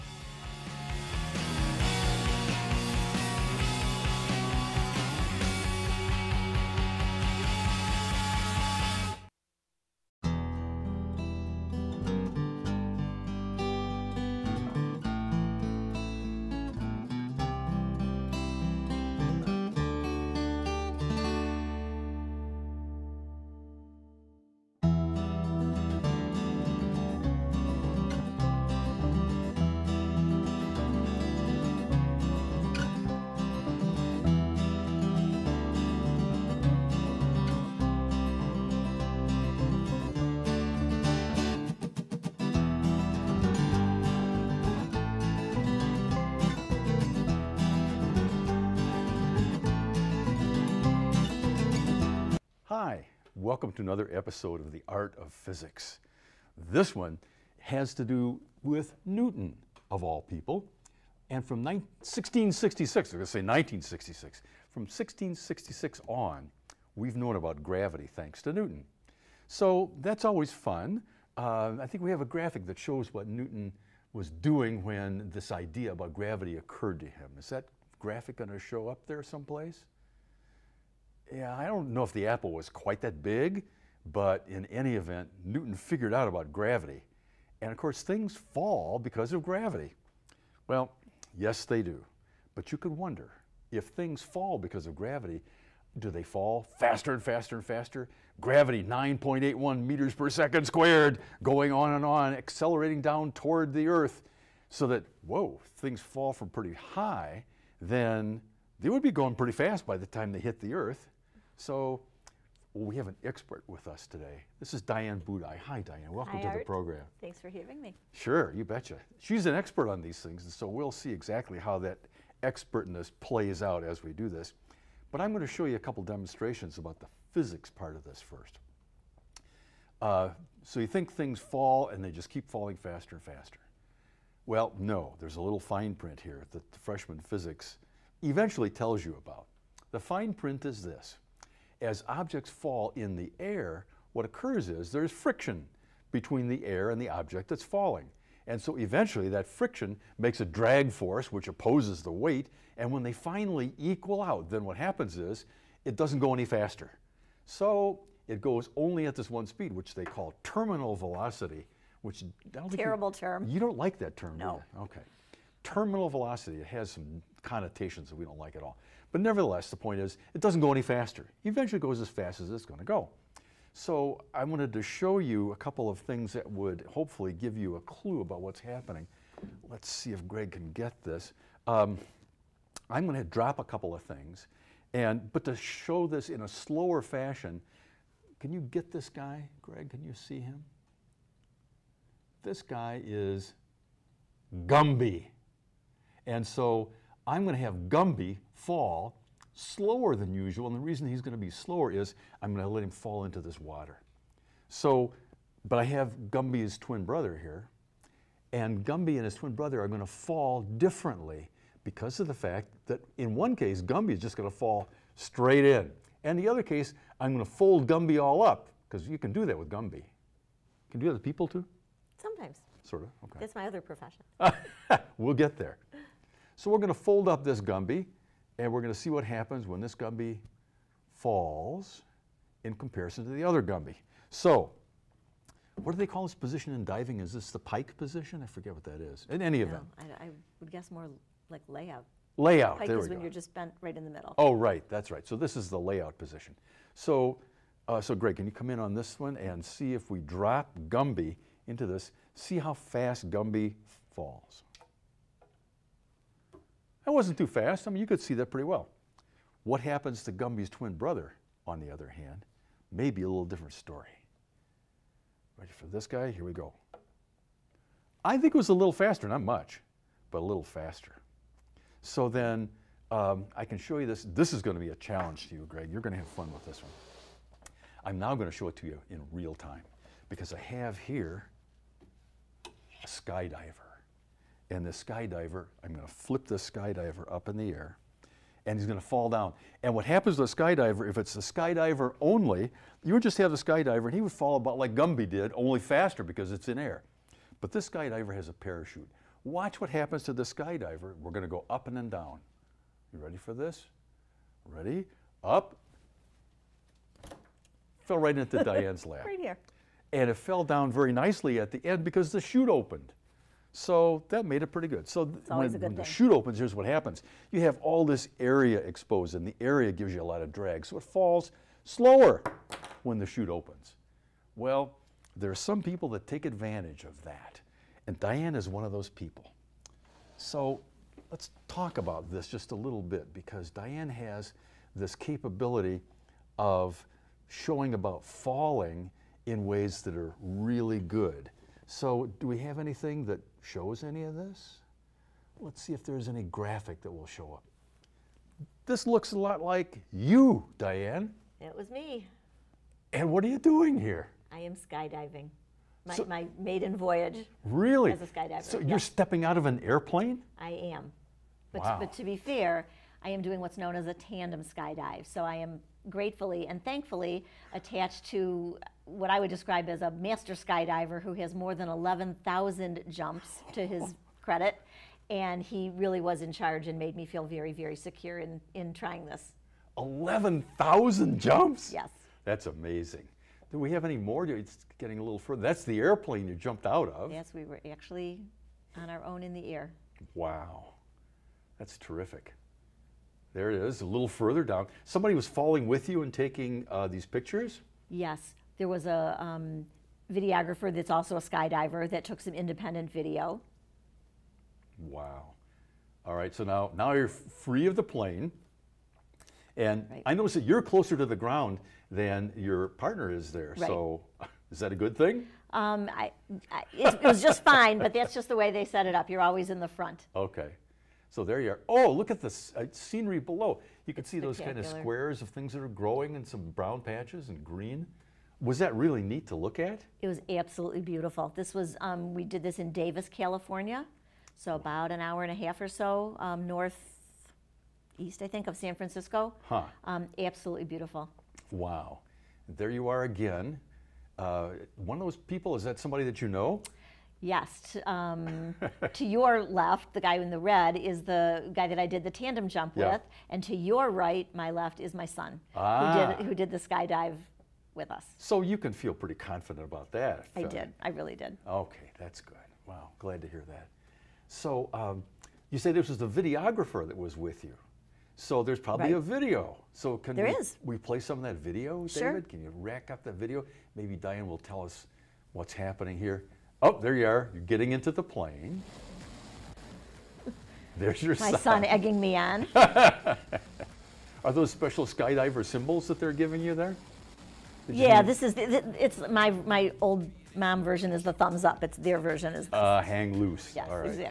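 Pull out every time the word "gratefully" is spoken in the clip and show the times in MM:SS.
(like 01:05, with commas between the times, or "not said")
06:06.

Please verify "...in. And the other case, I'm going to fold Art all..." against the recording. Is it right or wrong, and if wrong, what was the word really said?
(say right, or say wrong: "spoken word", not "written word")
wrong: "Gumby", not "Art".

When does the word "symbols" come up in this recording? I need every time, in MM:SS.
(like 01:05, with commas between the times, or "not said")
08:05.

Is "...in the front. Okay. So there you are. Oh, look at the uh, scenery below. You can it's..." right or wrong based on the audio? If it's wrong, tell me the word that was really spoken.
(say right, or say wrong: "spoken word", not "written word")
right.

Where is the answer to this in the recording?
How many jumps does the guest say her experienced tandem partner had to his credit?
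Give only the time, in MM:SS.
06:11.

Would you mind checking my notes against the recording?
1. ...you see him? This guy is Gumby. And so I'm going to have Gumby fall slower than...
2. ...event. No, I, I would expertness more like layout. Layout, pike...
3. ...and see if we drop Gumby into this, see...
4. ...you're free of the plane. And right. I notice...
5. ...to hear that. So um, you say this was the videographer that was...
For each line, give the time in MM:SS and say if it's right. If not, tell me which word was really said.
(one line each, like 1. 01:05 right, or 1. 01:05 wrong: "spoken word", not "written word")
1. 03:10 right
2. 03:59 wrong: "guess", not "expertness"
3. 04:09 right
4. 06:47 right
5. 07:43 right.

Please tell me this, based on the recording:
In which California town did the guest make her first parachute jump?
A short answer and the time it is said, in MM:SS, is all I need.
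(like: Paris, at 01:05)
Davis, at 07:12.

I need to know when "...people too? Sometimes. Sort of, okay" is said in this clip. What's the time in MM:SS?
03:41.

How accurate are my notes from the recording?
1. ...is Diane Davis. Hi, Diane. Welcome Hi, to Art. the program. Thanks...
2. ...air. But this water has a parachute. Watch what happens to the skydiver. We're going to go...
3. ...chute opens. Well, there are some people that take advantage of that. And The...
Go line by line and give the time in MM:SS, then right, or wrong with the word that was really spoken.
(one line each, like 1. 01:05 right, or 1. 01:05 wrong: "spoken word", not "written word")
1. 01:54 wrong: "Budaj", not "Davis"
2. 04:56 wrong: "skydiver", not "water"
3. 05:23 wrong: "Diane", not "The".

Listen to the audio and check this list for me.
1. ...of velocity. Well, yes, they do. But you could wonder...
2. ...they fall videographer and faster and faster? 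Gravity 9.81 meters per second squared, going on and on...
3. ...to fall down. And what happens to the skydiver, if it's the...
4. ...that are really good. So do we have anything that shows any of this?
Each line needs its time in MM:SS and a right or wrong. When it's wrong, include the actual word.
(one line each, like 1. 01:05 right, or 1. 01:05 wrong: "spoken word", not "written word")
1. 01:29 wrong: "gravity", not "velocity"
2. 01:36 wrong: "faster", not "videographer"
3. 04:48 right
4. 05:40 right.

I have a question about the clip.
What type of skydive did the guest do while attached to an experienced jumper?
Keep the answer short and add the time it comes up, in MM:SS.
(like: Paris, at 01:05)
tandem skydive, at 06:04.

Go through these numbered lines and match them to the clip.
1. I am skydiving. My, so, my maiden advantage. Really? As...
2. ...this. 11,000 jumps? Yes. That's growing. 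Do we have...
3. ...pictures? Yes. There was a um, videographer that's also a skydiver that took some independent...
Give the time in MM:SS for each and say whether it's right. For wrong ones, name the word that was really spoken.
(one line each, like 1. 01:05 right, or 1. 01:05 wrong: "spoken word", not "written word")
1. 05:54 wrong: "voyage", not "advantage"
2. 06:19 wrong: "amazing", not "growing"
3. 06:37 right.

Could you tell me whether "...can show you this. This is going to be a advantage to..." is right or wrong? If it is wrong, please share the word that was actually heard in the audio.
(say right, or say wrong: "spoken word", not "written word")
wrong: "challenge", not "advantage".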